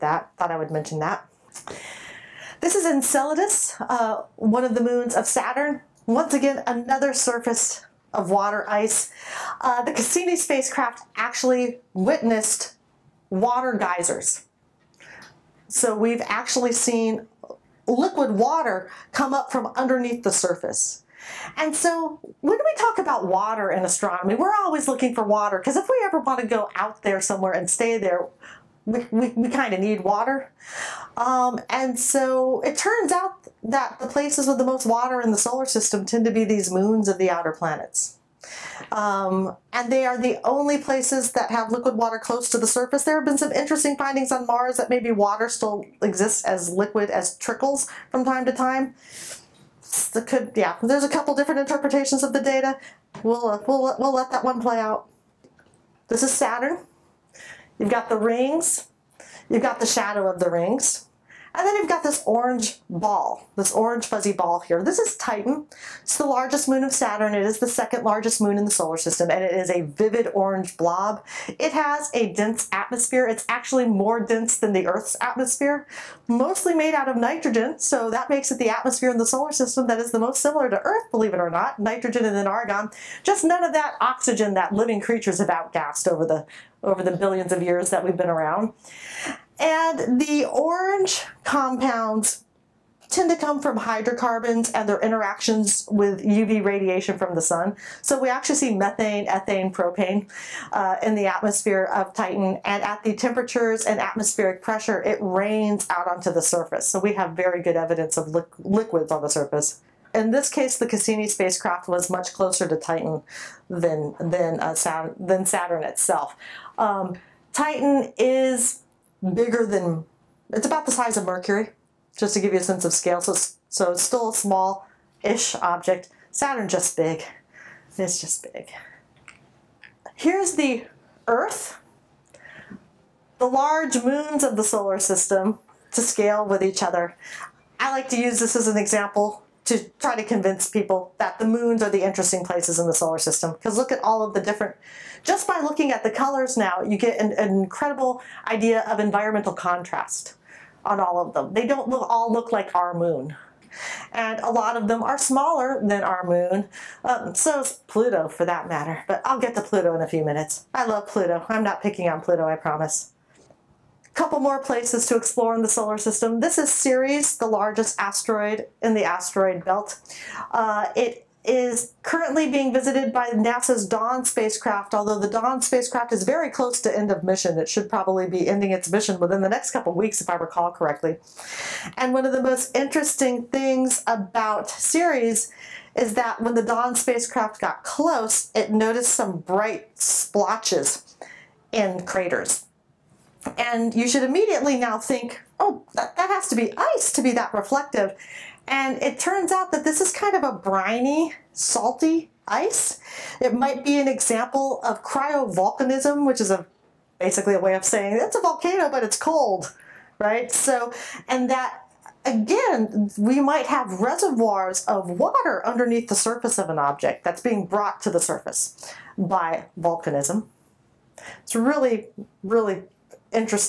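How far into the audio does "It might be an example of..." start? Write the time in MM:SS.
03:23.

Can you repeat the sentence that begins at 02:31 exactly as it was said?
They don't look, all look like our moon.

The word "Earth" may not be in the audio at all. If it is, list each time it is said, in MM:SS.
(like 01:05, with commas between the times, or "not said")
01:14, 01:20, 02:11.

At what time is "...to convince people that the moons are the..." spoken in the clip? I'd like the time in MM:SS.
02:20.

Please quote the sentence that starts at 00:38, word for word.
Um, and they are the only places that have liquid water close to the surface.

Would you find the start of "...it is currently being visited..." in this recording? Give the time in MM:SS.
02:50.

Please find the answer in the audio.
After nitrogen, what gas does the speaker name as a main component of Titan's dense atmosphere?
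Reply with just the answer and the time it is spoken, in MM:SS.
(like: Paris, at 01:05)
Argon, at 01:22.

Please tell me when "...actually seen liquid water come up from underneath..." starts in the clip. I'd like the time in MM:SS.
00:16.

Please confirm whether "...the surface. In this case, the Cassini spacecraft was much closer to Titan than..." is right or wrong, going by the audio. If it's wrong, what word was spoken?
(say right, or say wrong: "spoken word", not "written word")
right.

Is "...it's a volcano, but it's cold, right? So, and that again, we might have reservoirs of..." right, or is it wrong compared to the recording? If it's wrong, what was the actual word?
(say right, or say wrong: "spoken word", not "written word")
right.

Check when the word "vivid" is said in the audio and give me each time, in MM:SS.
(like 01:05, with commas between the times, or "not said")
01:09.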